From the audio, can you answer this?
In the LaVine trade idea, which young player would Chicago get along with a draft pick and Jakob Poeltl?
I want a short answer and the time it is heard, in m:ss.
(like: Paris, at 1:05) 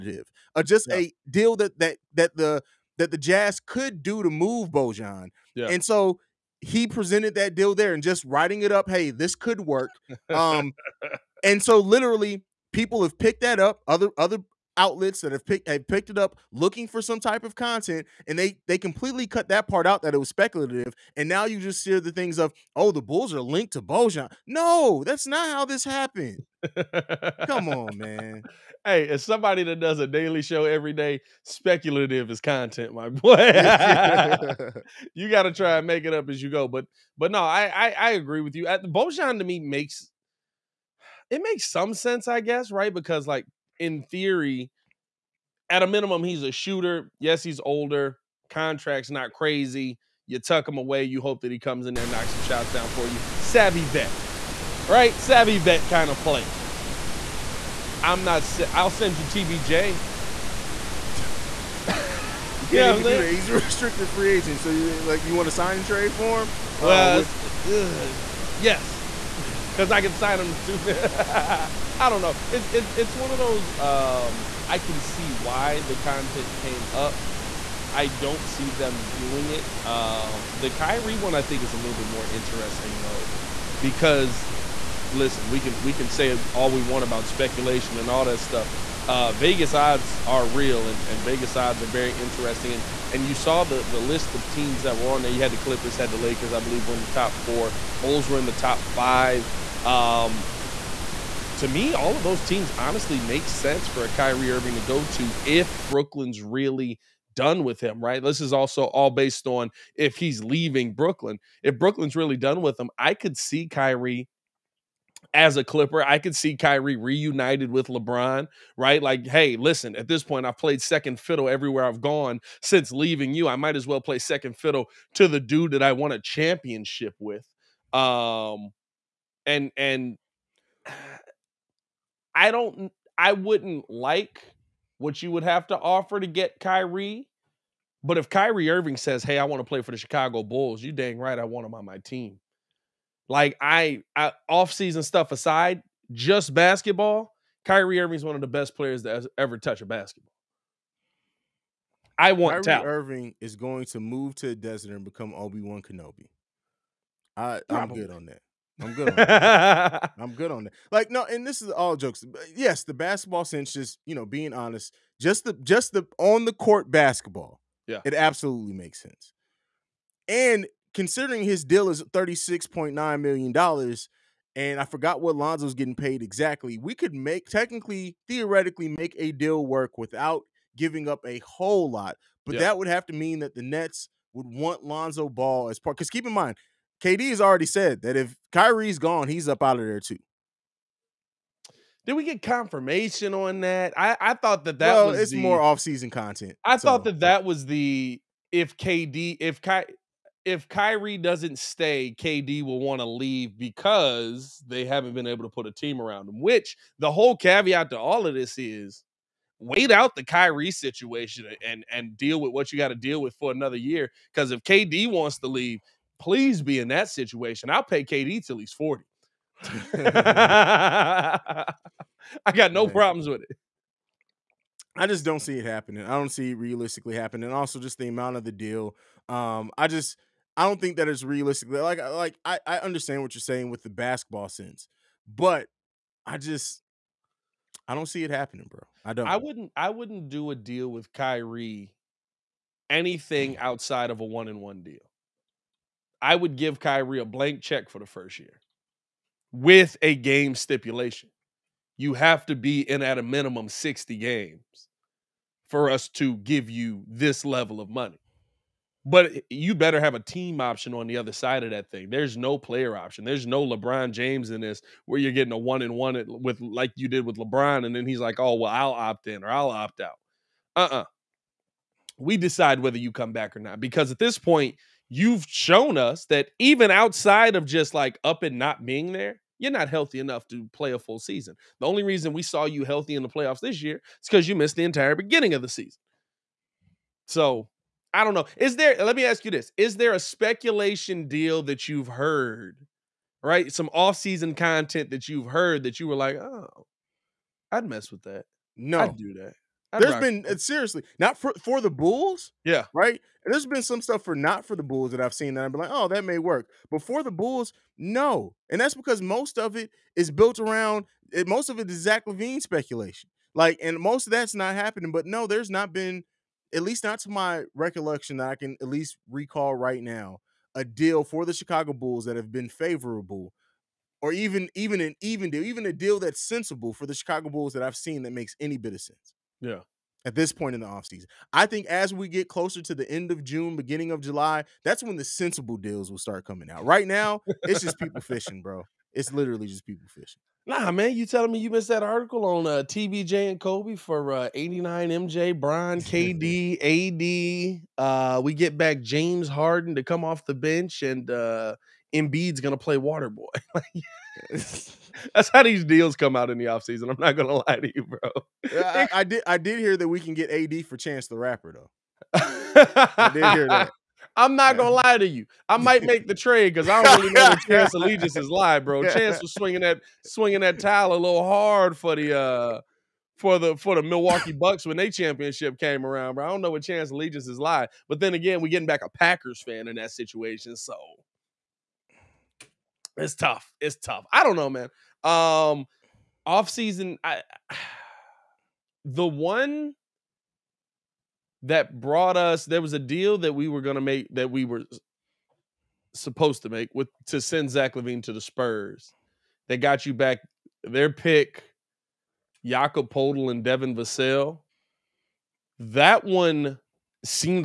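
Devin Vassell, at 6:43.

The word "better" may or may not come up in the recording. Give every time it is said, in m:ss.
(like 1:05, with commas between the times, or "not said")
4:19.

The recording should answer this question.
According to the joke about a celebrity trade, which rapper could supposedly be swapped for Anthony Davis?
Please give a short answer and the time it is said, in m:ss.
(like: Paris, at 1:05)
Chance the Rapper, at 6:00.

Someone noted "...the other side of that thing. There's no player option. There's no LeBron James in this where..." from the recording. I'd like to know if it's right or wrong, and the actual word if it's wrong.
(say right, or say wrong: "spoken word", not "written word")
right.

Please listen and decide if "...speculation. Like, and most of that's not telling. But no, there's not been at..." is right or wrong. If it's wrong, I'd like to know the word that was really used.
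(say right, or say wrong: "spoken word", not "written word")
wrong: "happening", not "telling".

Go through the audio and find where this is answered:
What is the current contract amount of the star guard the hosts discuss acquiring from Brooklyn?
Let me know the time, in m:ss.
2:52.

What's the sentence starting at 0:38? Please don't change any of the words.
Bojan to me makes it makes some sense, I guess, right?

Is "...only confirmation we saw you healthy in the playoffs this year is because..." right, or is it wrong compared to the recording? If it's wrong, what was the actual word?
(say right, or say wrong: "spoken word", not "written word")
wrong: "reason", not "confirmation".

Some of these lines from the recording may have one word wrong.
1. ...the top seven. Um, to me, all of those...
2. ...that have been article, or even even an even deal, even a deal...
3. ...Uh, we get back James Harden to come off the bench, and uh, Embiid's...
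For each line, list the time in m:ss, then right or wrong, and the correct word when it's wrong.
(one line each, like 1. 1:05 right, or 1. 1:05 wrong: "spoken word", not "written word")
1. 1:38 wrong: "five", not "seven"
2. 5:22 wrong: "favorable", not "article"
3. 5:47 right.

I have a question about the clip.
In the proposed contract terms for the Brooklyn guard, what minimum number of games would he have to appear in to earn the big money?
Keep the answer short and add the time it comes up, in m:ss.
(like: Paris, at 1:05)
60, at 4:13.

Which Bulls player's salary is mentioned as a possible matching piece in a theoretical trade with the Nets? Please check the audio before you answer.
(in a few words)
Lonzo Ball.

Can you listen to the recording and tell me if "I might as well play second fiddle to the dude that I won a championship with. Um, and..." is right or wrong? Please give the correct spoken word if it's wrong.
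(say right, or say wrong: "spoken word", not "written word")
right.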